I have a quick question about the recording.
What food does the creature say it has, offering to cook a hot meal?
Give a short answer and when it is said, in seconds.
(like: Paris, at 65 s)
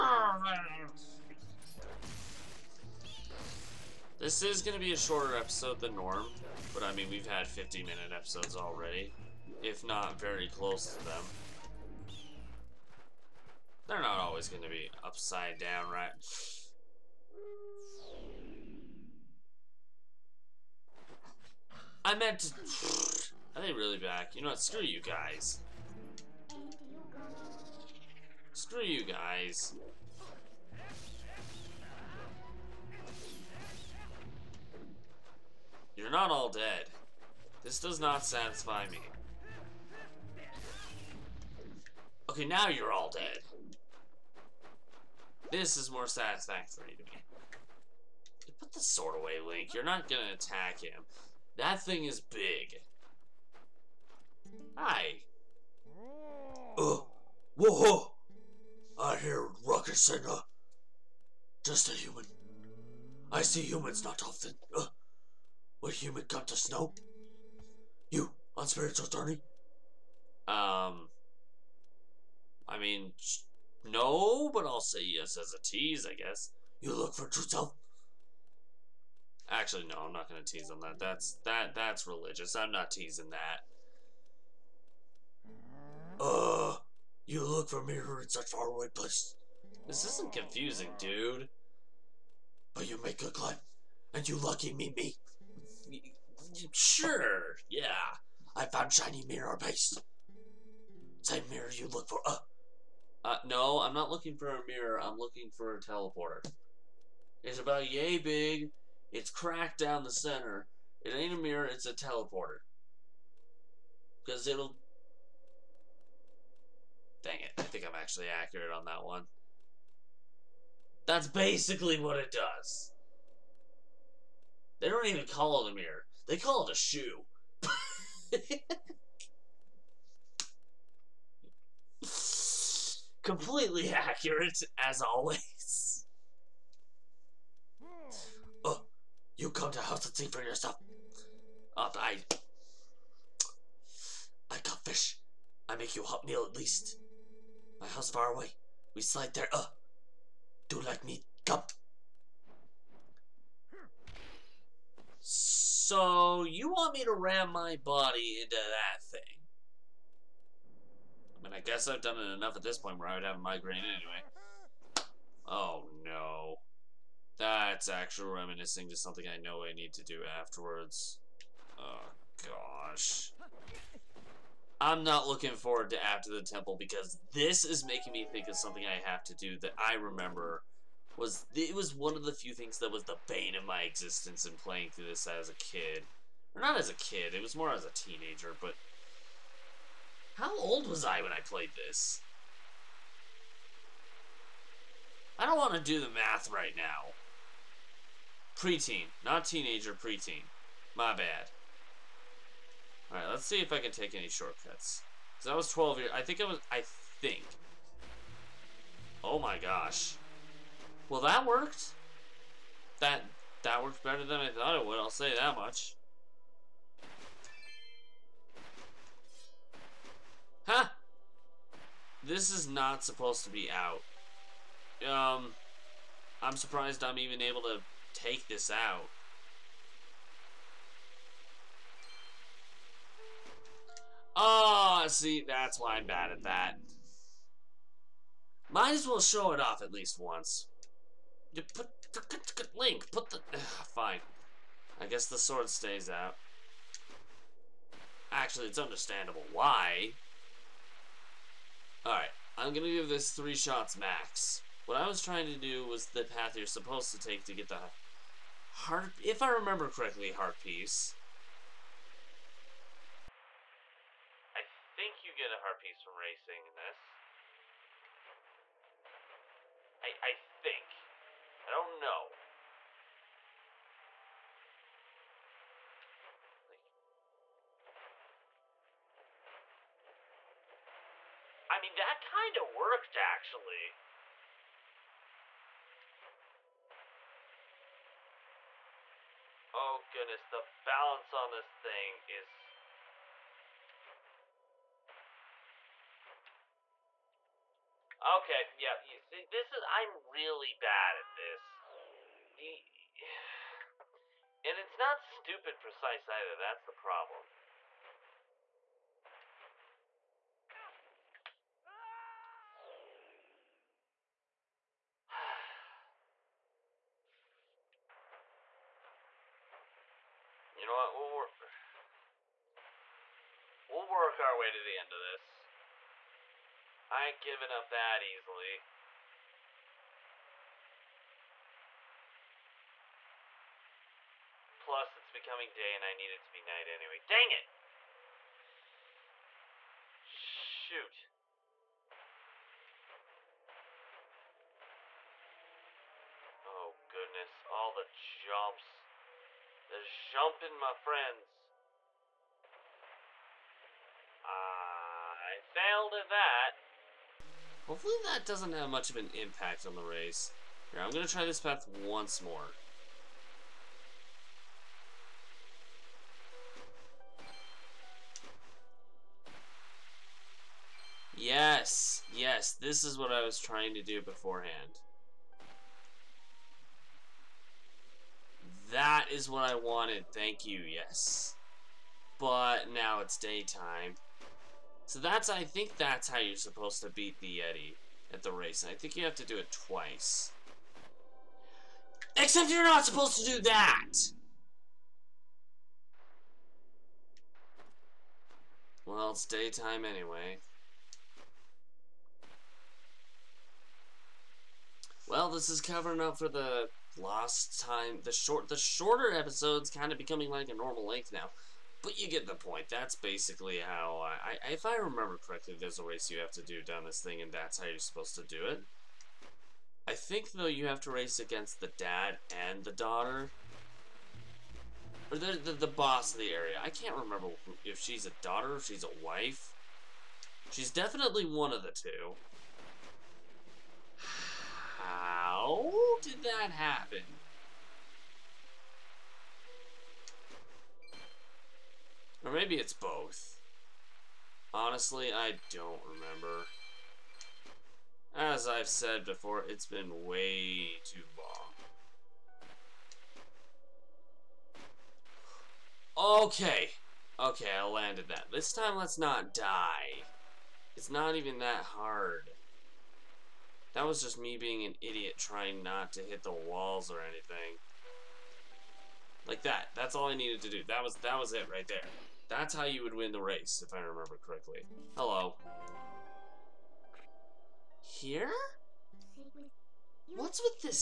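Fish, at 144 s.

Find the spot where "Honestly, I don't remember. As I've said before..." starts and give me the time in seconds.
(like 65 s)
444 s.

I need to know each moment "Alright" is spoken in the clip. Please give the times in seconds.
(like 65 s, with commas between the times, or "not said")
203 s, 252 s.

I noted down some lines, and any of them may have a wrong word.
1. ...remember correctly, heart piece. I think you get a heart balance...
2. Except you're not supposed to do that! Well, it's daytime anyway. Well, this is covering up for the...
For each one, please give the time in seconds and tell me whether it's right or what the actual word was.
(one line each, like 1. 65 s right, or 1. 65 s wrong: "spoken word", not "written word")
1. 259 s wrong: "piece", not "balance"
2. 392 s right.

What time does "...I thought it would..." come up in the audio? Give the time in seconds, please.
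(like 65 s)
214 s.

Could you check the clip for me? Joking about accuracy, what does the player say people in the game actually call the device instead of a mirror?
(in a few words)
A shoe.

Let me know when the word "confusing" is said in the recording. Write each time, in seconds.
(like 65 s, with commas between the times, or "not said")
90 s.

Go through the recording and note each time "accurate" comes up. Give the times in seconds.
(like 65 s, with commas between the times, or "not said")
118 s, 133 s.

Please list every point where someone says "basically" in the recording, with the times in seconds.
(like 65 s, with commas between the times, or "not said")
121 s, 413 s.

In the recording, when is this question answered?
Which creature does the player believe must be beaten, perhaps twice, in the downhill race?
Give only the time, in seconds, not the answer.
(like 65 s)
387 s.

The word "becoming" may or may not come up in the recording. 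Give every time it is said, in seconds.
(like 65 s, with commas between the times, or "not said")
335 s, 410 s.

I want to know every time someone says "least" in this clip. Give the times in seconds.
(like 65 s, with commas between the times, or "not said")
146 s, 239 s.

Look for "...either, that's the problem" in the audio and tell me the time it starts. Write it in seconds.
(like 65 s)
306 s.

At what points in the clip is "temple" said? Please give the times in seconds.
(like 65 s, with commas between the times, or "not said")
176 s.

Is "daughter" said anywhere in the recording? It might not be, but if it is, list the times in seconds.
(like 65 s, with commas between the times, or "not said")
422 s, 428 s.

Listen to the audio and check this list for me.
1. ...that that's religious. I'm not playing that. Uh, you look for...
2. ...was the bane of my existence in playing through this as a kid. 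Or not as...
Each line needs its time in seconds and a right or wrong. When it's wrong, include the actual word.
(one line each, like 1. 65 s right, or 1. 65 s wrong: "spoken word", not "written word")
1. 81 s wrong: "teasing", not "playing"
2. 182 s right.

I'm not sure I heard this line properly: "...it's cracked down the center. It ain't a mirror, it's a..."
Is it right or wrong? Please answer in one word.
right.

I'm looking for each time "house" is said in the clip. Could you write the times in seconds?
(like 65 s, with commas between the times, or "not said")
139 s, 147 s.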